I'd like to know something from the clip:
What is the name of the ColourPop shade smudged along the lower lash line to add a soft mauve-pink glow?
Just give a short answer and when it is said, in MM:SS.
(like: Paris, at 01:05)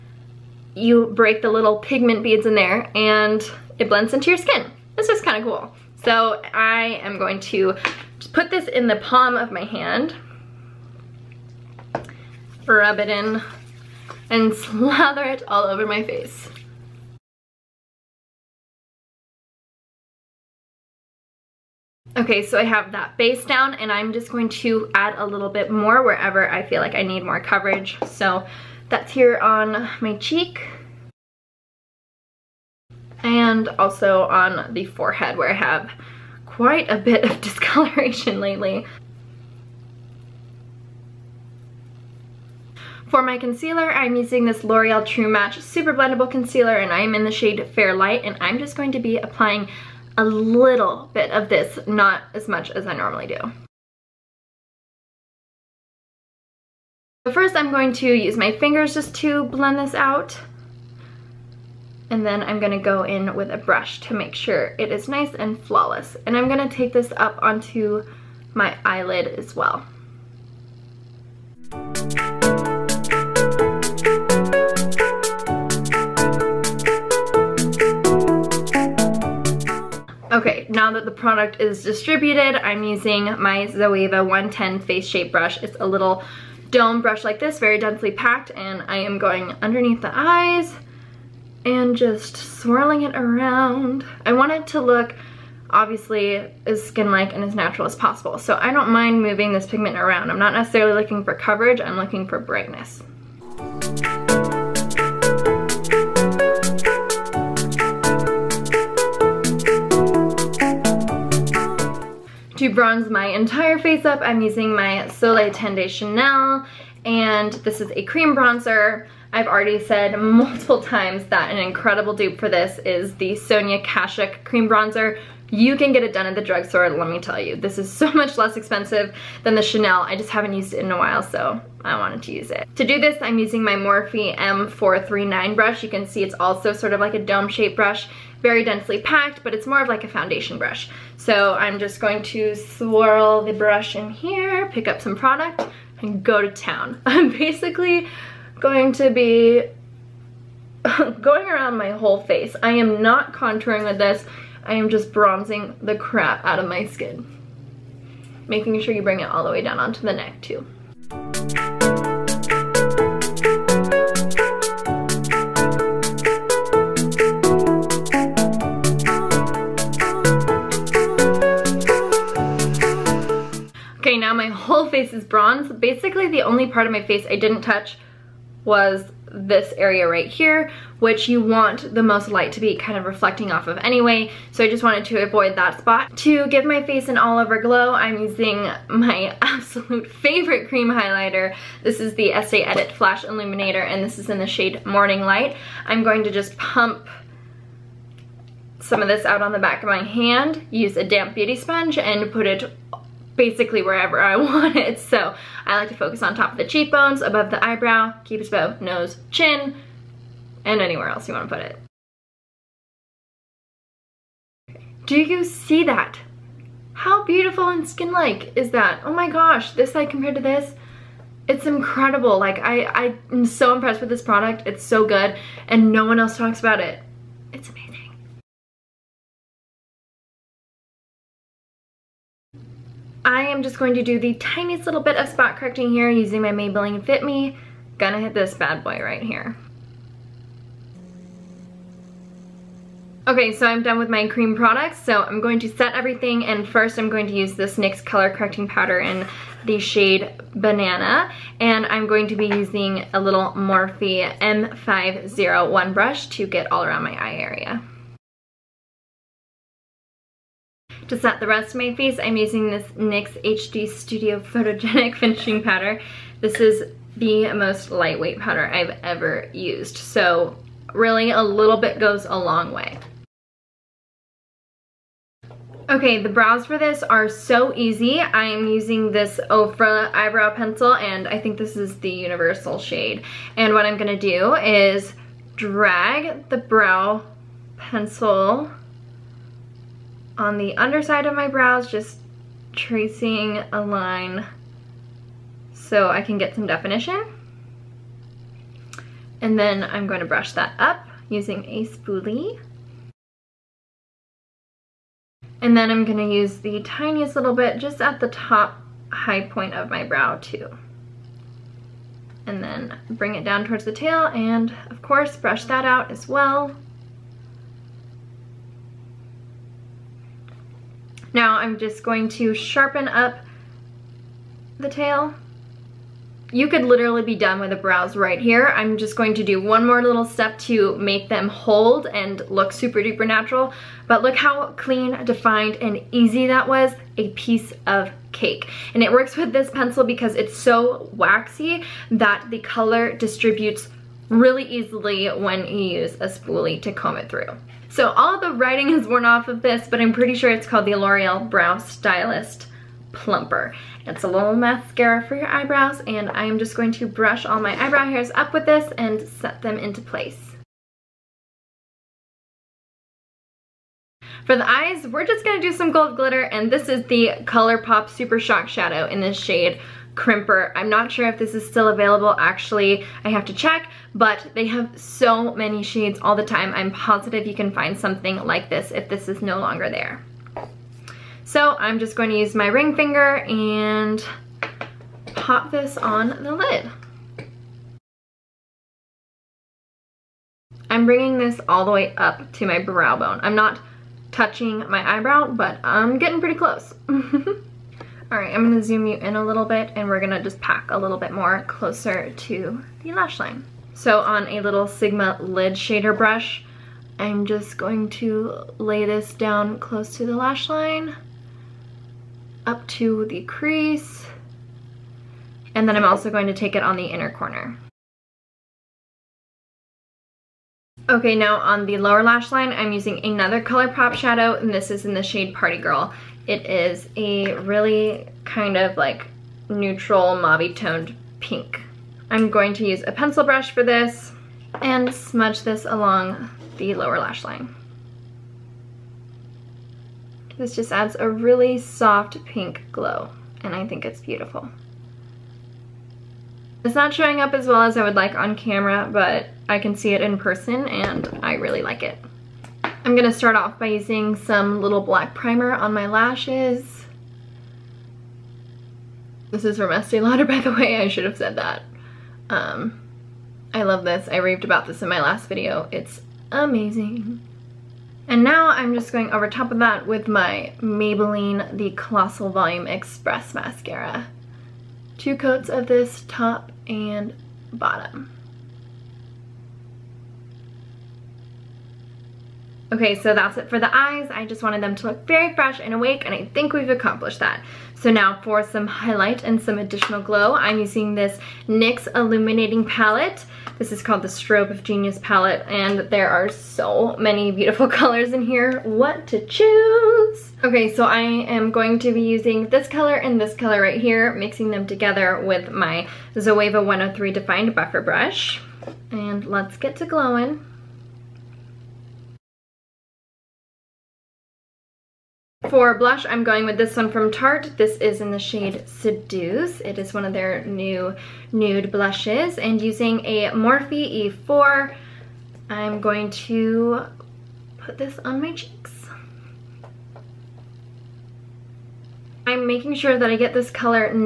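Party Girl, at 07:05.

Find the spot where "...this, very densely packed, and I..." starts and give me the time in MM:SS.
01:27.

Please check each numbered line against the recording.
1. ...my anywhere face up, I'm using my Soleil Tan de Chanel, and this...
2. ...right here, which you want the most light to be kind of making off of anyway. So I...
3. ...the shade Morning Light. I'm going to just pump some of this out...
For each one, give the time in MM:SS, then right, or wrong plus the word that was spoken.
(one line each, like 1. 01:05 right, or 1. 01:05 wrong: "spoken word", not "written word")
1. 01:53 wrong: "entire", not "anywhere"
2. 03:00 wrong: "reflecting", not "making"
3. 03:14 right.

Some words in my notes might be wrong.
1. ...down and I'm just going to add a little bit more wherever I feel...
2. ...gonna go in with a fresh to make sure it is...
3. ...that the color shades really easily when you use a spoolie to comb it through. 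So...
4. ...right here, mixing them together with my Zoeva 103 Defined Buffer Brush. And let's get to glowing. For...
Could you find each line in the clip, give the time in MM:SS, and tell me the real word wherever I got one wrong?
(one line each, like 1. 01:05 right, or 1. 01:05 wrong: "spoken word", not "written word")
1. 00:23 right
2. 01:02 wrong: "brush", not "fresh"
3. 05:42 wrong: "distributes", not "shades"
4. 08:23 right.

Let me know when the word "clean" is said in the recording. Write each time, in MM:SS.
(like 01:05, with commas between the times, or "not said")
05:34.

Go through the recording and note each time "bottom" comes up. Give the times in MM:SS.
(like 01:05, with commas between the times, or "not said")
07:57.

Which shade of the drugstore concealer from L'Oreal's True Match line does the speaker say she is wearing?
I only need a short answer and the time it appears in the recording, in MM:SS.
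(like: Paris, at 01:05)
Fair Light, at 00:47.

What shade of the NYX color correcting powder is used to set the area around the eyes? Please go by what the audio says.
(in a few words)
Banana.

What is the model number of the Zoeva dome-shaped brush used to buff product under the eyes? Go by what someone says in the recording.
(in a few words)
110.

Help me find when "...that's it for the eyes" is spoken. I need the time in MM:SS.
08:03.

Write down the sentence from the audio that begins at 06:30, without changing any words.
I'm bringing this all the way up to my brow bone.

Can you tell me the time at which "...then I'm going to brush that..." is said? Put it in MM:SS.
04:59.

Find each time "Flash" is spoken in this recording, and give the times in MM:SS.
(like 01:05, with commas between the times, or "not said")
03:12.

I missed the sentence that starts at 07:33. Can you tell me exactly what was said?
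I'm gonna start off by using some little black primer on my lashes.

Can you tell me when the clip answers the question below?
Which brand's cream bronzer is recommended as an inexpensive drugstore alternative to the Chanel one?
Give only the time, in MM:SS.
02:03.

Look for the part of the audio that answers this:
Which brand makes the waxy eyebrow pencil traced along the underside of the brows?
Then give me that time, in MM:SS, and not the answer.
04:39.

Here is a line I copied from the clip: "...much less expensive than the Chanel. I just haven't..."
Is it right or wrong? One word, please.
right.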